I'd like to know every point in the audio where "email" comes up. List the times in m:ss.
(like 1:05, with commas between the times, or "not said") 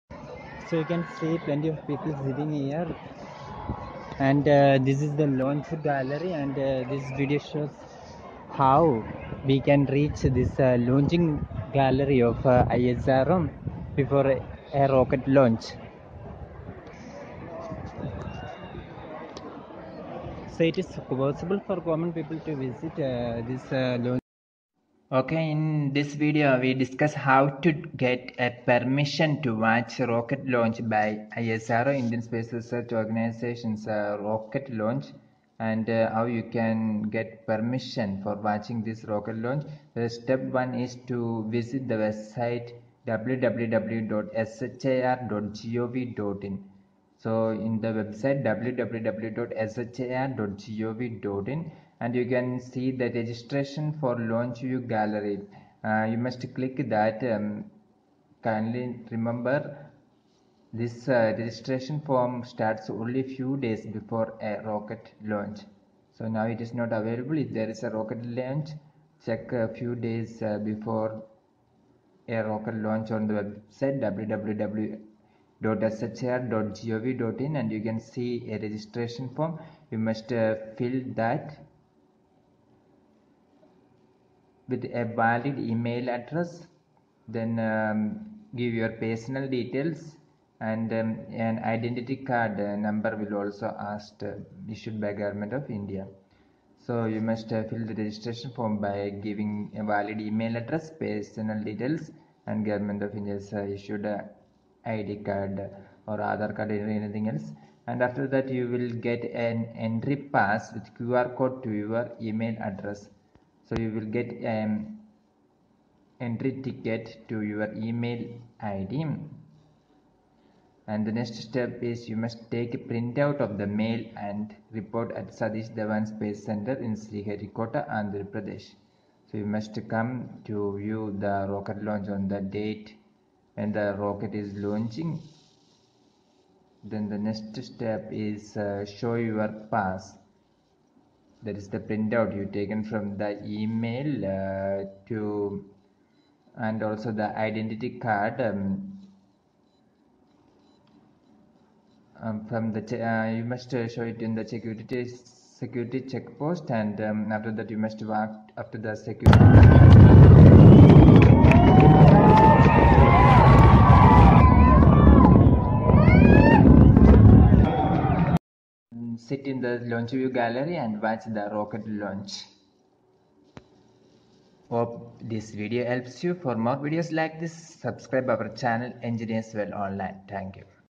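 1:25, 1:40, 1:52, 1:57, 2:23.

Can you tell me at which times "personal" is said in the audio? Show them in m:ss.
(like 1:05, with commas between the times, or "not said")
1:29, 1:41.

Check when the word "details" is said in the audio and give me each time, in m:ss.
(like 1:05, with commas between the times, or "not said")
1:29, 1:41.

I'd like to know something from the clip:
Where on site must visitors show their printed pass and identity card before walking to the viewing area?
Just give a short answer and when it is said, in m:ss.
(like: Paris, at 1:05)
Security check post, at 2:35.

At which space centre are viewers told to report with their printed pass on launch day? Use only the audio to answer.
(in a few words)
Satish Dhawan Space Center.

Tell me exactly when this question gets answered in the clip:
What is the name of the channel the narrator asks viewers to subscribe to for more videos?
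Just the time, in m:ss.
2:59.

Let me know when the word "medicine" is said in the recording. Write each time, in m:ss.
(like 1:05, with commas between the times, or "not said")
not said.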